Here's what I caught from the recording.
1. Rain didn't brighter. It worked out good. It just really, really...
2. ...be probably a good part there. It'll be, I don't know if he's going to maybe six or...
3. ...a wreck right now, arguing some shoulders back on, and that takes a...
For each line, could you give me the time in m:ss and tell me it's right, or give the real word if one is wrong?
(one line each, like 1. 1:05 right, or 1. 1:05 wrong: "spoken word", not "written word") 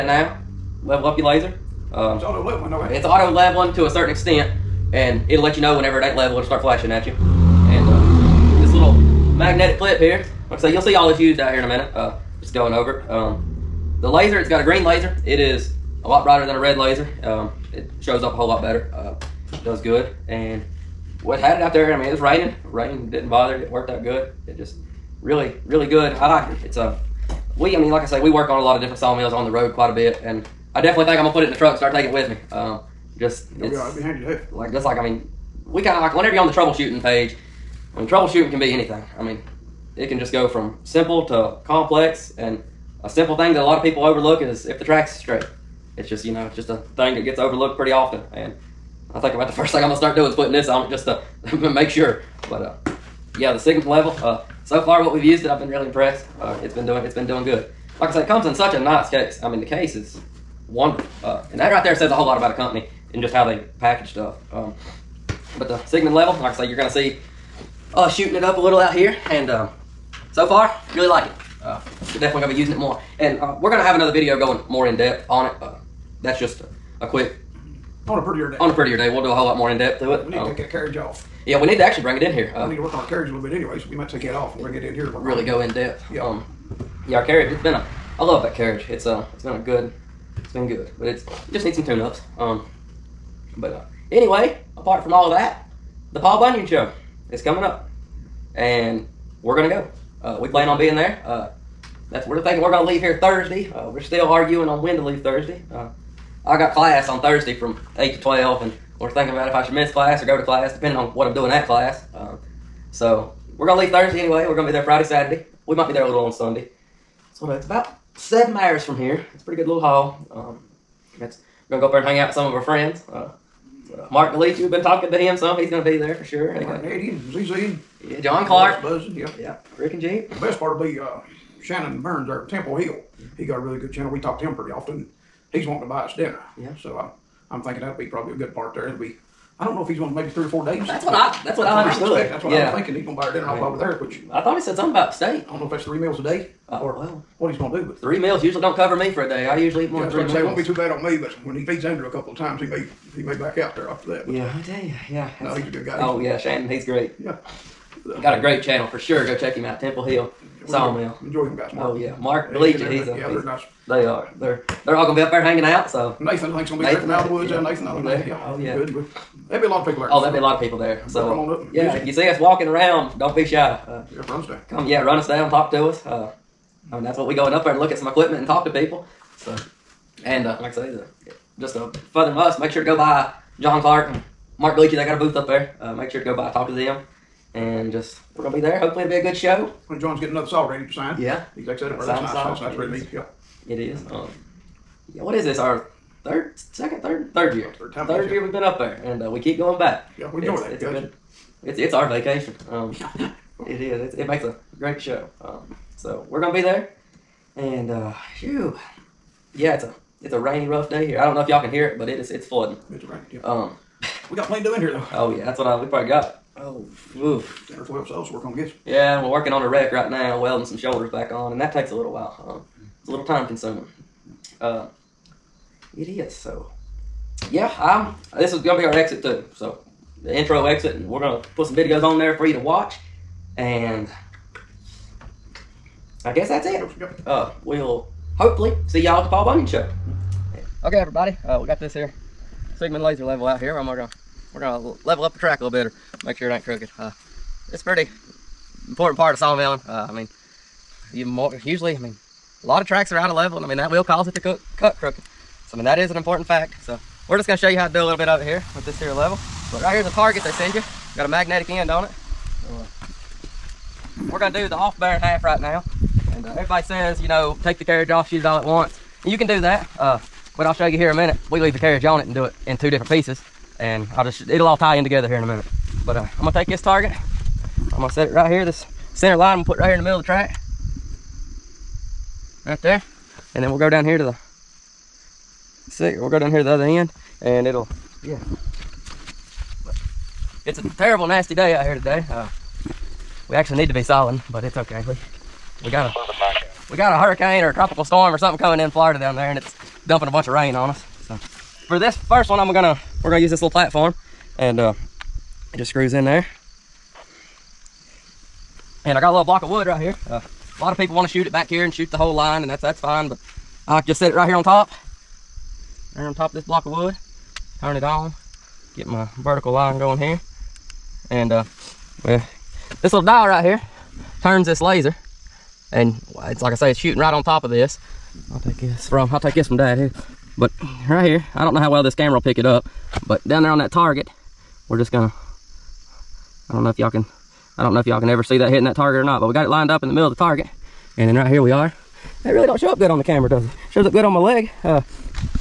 1. 0:22 wrong: "bother", not "brighter"
2. 2:17 wrong: "three", not "six"
3. 3:39 wrong: "welding", not "arguing".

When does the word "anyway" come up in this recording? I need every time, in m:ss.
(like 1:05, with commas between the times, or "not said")
1:23, 1:34, 1:54.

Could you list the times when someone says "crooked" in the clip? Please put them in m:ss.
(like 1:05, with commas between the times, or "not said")
4:06, 4:14.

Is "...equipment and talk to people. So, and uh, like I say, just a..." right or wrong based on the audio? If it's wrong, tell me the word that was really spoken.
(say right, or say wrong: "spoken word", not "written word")
right.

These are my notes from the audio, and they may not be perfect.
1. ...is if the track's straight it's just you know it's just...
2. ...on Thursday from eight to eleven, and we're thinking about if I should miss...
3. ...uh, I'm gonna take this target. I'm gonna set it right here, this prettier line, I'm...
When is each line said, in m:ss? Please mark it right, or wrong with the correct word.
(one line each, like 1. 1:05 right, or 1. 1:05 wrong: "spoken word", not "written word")
1. 0:44 right
2. 1:47 wrong: "twelve", not "eleven"
3. 4:36 wrong: "center", not "prettier".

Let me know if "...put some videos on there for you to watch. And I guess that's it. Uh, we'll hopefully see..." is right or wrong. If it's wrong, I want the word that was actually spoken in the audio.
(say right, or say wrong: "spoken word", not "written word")
right.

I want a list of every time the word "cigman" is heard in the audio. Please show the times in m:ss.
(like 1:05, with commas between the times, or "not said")
0:53, 1:05, 4:02.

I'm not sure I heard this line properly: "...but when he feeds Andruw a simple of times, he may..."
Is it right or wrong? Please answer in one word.
wrong.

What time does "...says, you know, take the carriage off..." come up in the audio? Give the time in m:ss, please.
4:26.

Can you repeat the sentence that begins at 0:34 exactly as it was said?
Like just like I mean, we kind of like whenever you're on the troubleshooting page, I mean troubleshooting can be anything.